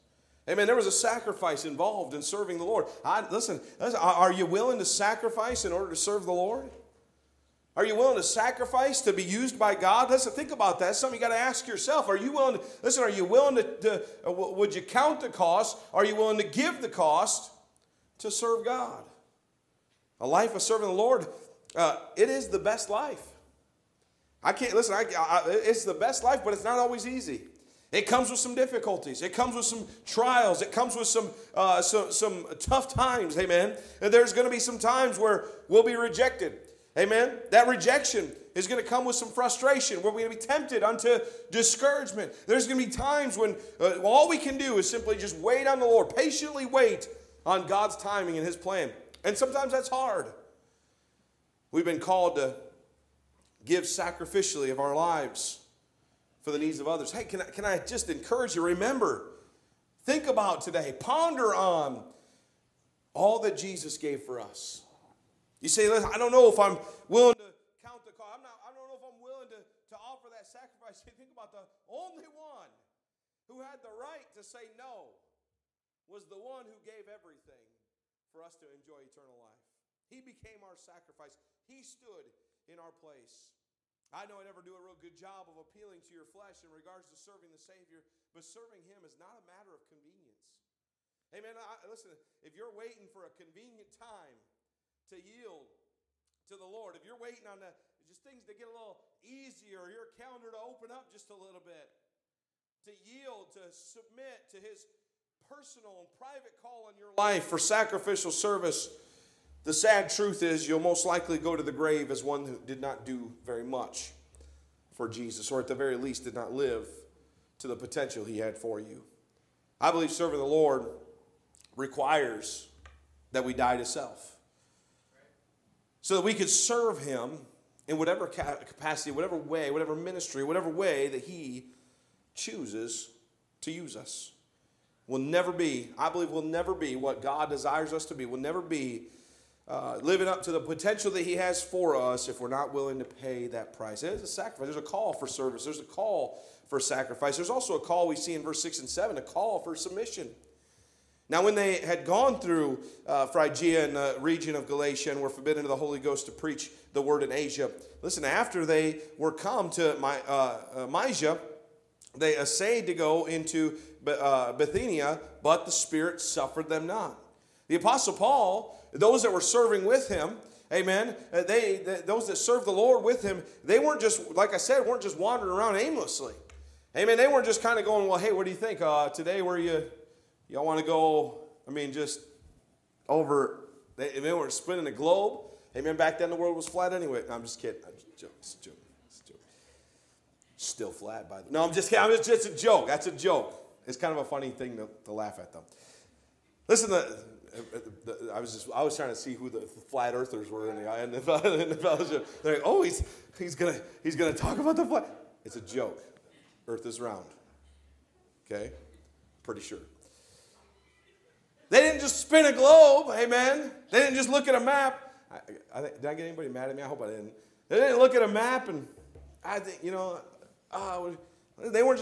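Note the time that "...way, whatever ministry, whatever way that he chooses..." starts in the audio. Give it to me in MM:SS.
02:09.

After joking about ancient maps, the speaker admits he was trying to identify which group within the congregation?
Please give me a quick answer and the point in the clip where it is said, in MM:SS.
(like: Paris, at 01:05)
flat earthers, at 03:19.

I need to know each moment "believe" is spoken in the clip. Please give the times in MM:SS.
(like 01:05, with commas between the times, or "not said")
01:59, 02:16.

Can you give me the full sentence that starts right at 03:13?
It's kind of a funny thing to, to laugh at, though.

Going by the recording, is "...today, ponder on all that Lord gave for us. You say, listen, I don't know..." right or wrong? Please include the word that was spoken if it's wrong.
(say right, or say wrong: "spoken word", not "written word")
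wrong: "Jesus", not "Lord".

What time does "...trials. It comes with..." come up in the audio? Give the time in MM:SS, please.
00:30.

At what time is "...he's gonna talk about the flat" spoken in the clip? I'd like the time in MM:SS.
03:24.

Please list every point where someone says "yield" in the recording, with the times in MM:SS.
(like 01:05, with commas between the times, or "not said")
01:35, 01:42.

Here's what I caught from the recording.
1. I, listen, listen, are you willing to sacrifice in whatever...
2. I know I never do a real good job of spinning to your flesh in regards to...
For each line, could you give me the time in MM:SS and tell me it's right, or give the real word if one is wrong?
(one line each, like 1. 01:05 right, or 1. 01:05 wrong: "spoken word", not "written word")
1. 00:03 wrong: "order", not "whatever"
2. 01:24 wrong: "appealing", not "spinning".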